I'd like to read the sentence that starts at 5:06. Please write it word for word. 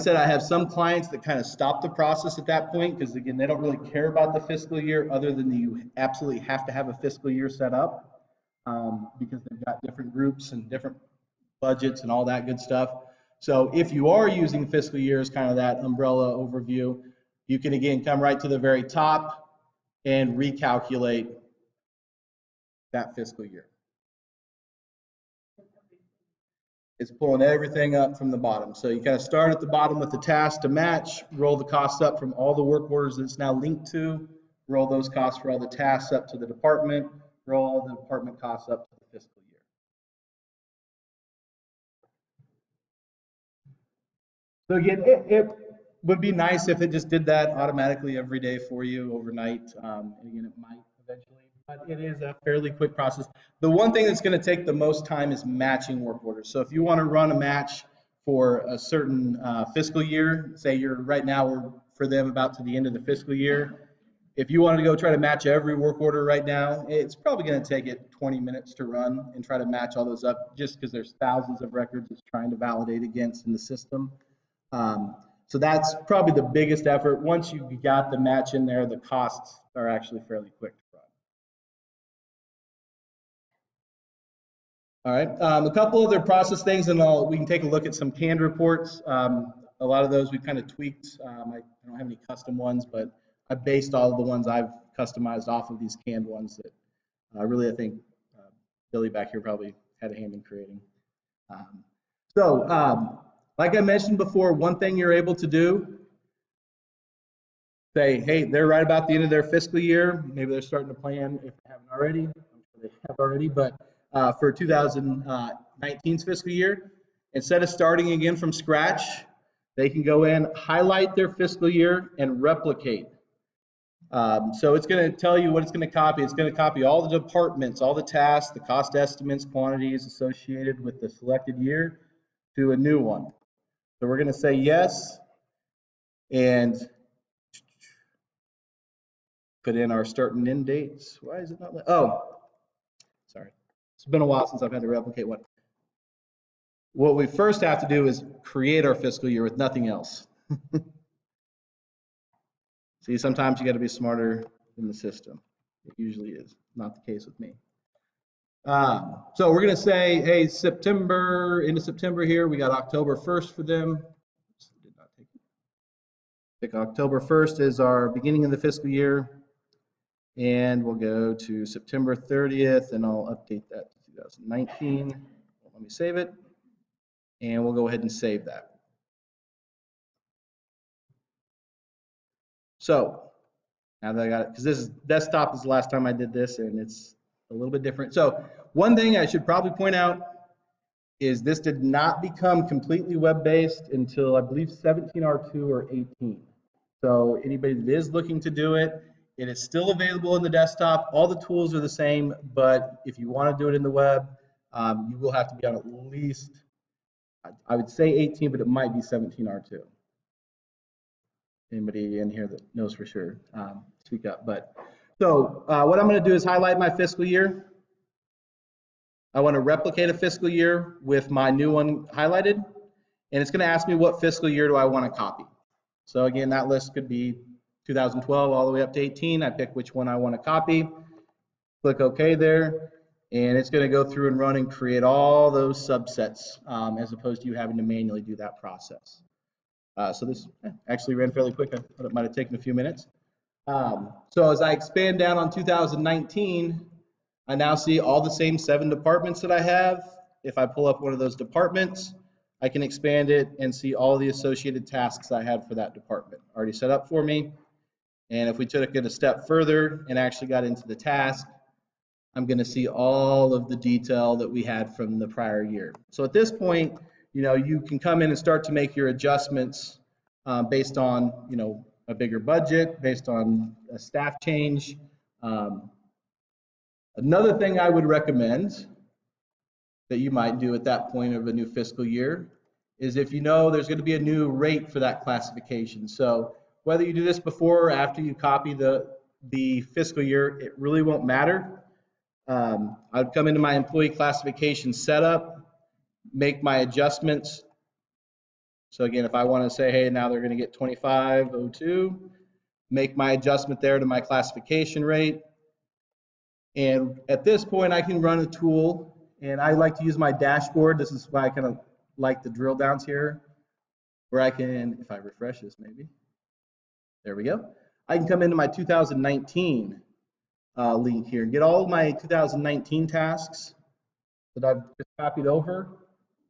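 And at this point, I can run a tool, and I like to use my dashboard.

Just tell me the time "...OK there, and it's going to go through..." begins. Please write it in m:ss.
3:51.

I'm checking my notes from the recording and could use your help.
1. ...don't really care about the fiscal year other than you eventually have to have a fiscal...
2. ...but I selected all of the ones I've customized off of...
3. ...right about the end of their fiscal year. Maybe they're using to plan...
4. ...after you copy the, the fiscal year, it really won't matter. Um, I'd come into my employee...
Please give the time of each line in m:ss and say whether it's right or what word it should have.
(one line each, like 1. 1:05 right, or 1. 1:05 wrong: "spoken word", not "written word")
1. 0:03 wrong: "absolutely", not "eventually"
2. 1:32 wrong: "based", not "selected"
3. 1:48 wrong: "starting", not "using"
4. 4:47 right.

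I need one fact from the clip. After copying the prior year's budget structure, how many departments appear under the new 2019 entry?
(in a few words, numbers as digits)
7.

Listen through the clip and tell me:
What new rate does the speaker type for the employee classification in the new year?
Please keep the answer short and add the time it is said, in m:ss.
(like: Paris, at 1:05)
2502, at 5:00.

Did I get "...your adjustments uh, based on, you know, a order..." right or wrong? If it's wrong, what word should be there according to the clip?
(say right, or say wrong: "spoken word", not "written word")
wrong: "bigger", not "order".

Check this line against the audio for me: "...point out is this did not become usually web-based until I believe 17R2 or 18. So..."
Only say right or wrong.
wrong.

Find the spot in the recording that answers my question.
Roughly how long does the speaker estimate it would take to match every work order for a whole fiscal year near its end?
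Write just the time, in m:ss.
1:08.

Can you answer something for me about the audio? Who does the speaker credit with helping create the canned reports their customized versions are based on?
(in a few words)
Billy.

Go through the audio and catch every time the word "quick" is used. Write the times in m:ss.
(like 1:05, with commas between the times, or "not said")
0:52, 1:20, 4:01.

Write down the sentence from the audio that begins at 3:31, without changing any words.
Anybody in here that knows for sure, um, speak up.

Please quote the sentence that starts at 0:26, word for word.
It's pulling everything up from the bottom.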